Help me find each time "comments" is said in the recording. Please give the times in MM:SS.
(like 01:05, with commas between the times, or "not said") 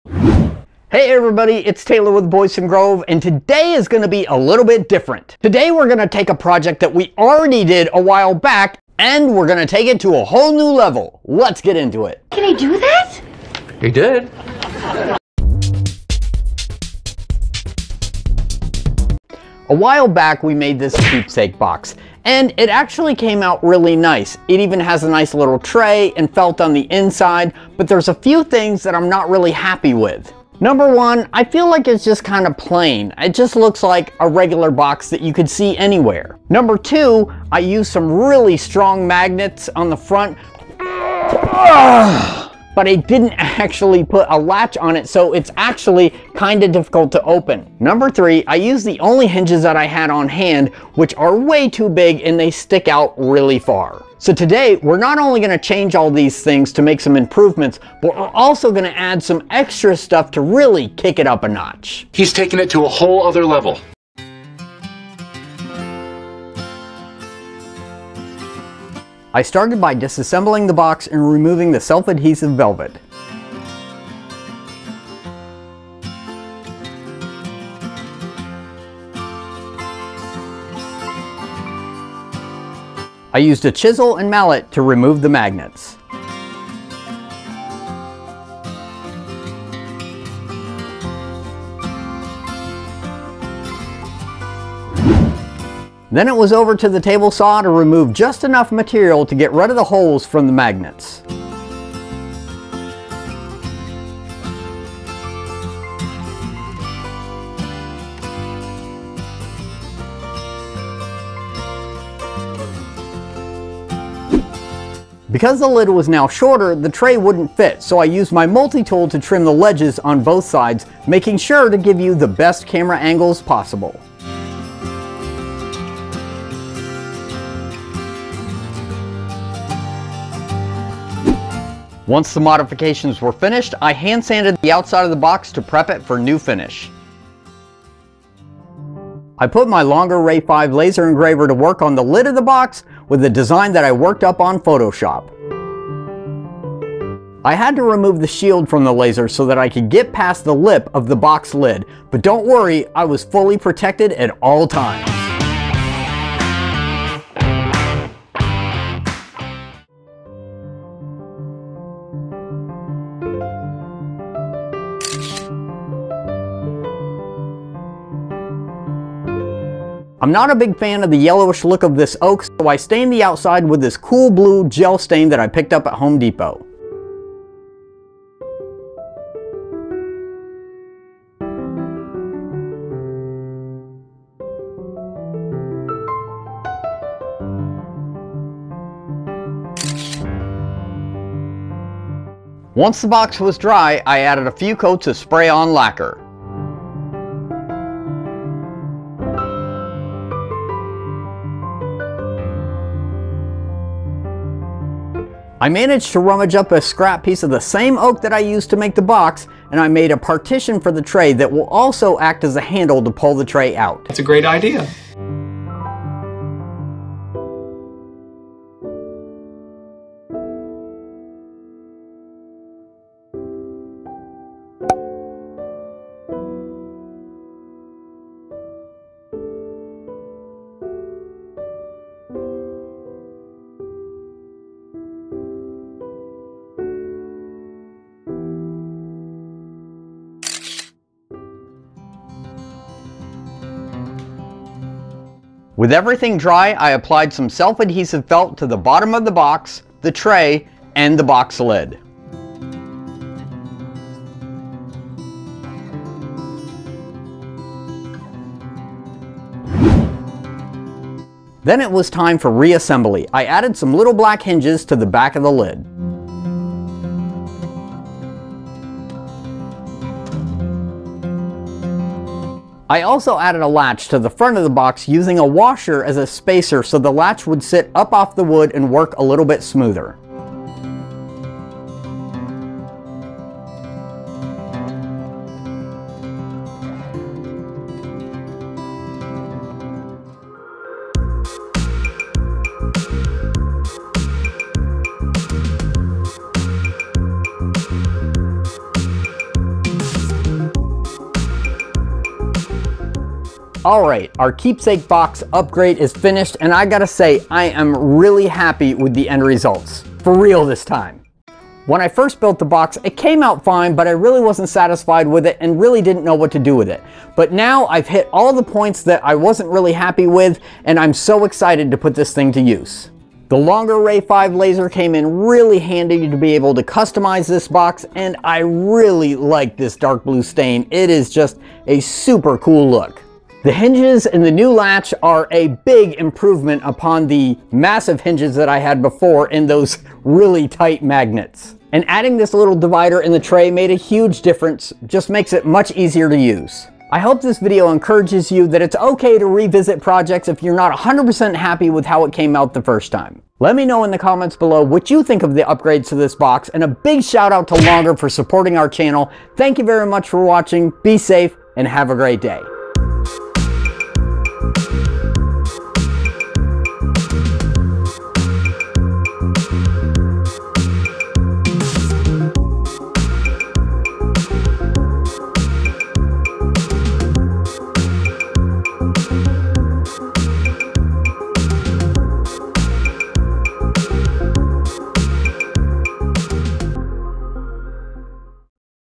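05:54.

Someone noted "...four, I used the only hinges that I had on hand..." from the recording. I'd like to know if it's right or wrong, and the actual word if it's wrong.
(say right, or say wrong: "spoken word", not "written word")
wrong: "three", not "four".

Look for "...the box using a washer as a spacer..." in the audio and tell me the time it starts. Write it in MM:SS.
04:34.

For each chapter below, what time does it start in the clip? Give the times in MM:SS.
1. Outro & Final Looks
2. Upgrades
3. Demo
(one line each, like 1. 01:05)
1. 04:52
2. 02:18
3. 01:09.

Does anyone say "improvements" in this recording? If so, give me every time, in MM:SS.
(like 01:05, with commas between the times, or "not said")
00:57, 05:36.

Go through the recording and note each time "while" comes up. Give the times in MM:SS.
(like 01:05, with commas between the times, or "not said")
00:08, 00:19.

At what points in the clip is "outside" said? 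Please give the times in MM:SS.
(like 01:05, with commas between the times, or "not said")
02:14, 02:53.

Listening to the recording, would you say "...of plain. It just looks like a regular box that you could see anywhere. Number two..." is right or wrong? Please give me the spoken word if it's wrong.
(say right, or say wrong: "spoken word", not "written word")
right.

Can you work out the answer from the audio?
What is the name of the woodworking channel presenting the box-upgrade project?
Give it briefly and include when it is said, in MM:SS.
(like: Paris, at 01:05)
Boydston Grove, at 00:02.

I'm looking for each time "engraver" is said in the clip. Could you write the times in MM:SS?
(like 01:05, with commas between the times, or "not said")
02:21.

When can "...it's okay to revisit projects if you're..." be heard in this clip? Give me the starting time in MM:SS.
05:48.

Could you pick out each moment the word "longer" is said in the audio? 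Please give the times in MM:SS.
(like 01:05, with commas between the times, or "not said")
02:19, 05:23, 05:57.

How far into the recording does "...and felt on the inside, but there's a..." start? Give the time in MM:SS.
00:26.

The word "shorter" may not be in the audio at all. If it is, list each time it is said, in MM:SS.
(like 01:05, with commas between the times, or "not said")
01:56.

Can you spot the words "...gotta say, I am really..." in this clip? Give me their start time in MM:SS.
05:06.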